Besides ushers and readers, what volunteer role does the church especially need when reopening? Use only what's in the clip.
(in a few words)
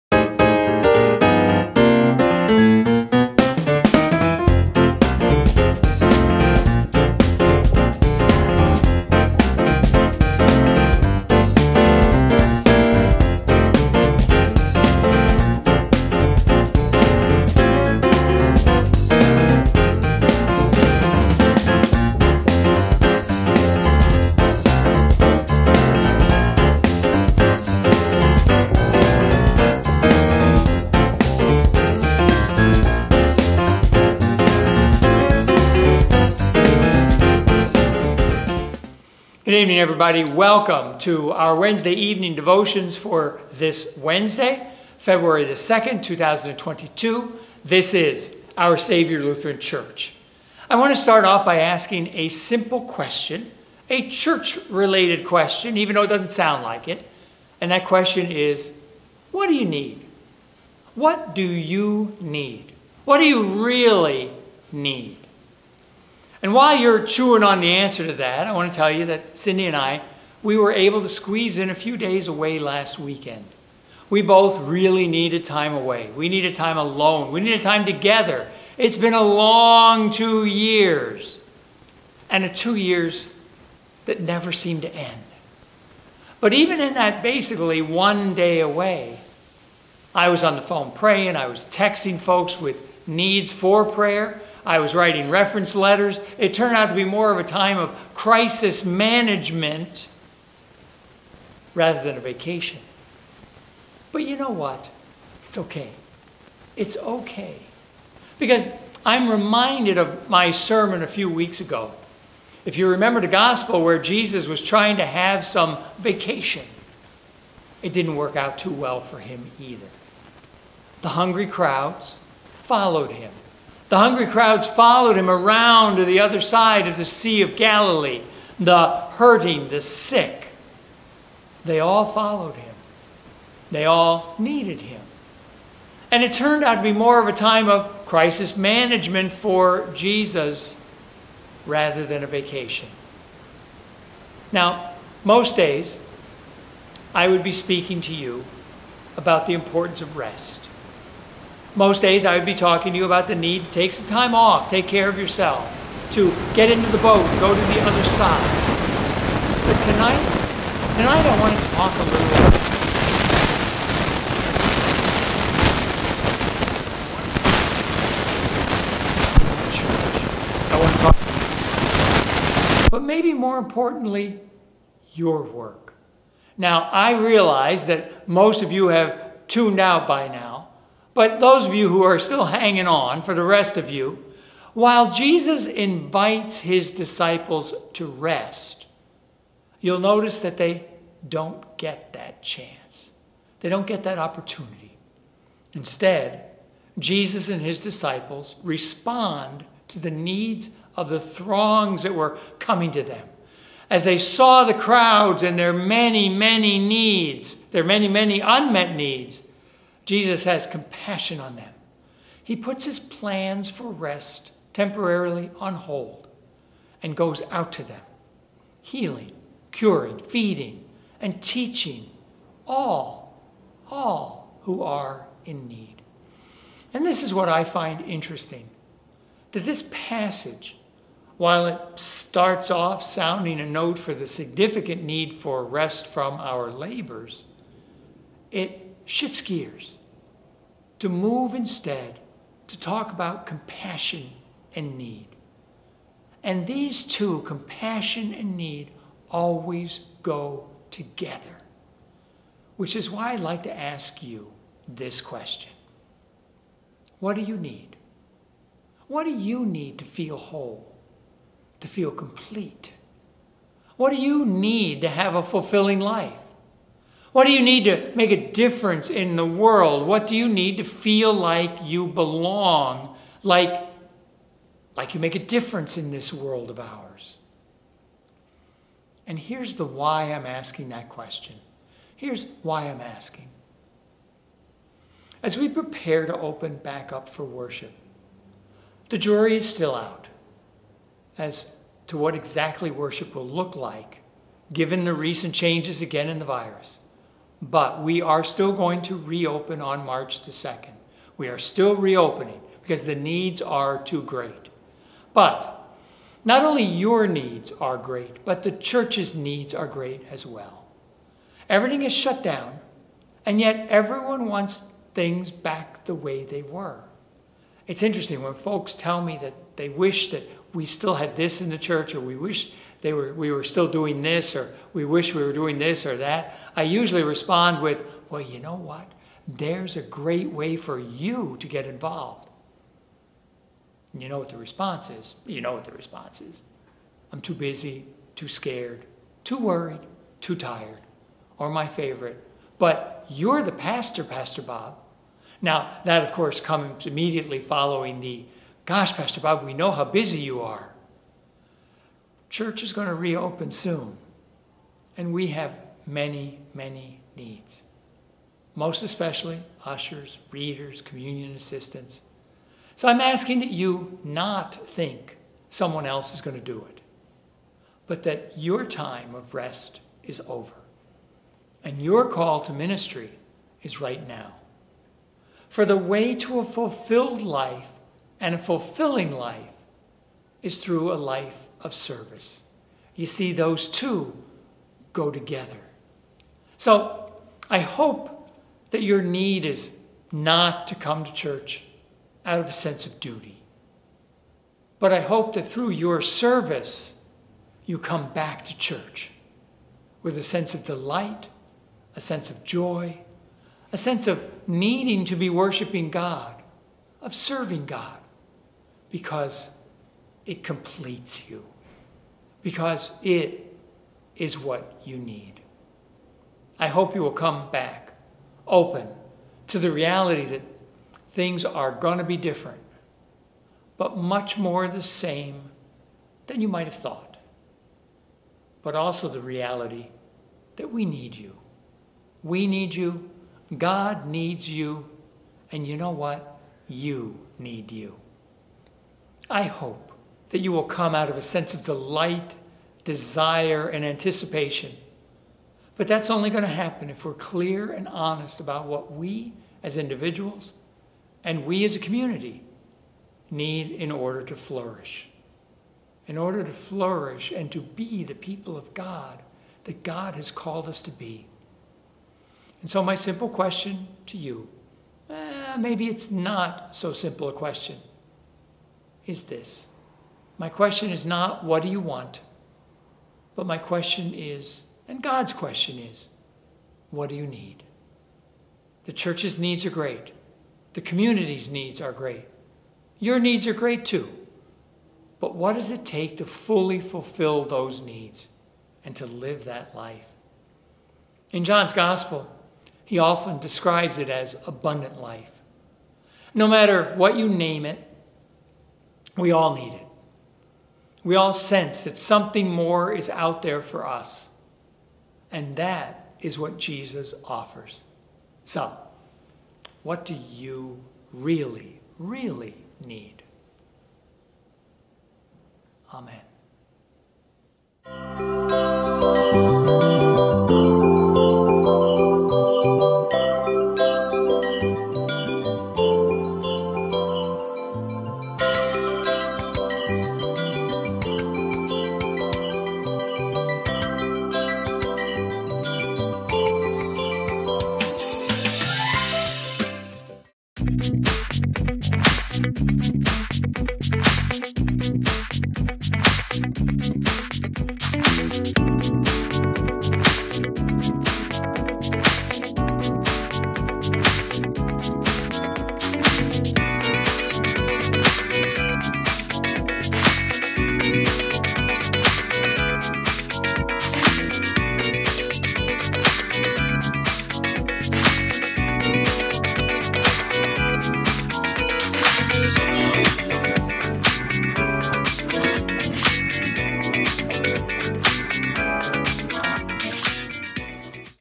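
Communion assistants.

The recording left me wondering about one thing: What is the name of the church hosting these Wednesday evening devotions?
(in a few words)
Our Saviour Lutheran Church.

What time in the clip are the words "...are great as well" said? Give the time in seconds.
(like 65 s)
309 s.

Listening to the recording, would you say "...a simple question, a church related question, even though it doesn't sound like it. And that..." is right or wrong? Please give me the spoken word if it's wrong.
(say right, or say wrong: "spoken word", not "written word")
right.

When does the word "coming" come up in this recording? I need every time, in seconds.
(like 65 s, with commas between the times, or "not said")
202 s.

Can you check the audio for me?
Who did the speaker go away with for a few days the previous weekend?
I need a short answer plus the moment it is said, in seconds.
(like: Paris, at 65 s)
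Cindy, at 69 s.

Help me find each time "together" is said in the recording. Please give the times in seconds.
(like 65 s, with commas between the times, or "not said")
77 s, 250 s, 385 s.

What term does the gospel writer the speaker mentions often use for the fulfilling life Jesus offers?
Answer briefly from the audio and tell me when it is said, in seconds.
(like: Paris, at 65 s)
Abundant life, at 494 s.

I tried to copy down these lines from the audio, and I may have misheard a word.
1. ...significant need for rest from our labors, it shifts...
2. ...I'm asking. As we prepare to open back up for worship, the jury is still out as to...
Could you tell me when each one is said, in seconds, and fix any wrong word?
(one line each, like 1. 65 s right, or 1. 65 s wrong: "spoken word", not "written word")
1. 234 s right
2. 282 s right.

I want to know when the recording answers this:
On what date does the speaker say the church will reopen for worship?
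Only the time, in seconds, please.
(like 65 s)
300 s.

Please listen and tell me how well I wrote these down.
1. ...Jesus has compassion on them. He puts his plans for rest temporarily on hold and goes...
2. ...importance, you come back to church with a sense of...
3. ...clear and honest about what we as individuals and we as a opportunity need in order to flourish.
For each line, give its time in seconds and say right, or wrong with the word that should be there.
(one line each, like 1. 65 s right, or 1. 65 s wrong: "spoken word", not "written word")
1. 210 s right
2. 396 s wrong: "service", not "importance"
3. 447 s wrong: "community", not "opportunity".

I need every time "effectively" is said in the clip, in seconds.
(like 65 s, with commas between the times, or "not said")
not said.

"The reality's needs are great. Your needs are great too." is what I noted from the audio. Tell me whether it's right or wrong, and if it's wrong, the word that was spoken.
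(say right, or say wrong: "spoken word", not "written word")
wrong: "community", not "reality".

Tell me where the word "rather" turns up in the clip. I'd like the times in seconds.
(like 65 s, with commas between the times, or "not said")
101 s, 141 s.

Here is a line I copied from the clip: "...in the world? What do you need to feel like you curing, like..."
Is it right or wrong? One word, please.
wrong.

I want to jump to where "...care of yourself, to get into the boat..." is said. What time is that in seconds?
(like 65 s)
154 s.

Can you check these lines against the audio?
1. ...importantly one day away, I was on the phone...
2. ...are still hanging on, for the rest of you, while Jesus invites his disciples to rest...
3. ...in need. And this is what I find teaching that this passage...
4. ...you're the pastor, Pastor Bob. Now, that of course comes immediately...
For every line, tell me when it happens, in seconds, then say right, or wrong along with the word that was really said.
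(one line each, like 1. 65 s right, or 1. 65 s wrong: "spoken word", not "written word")
1. 87 s wrong: "basically", not "importantly"
2. 182 s right
3. 225 s wrong: "interesting", not "teaching"
4. 343 s right.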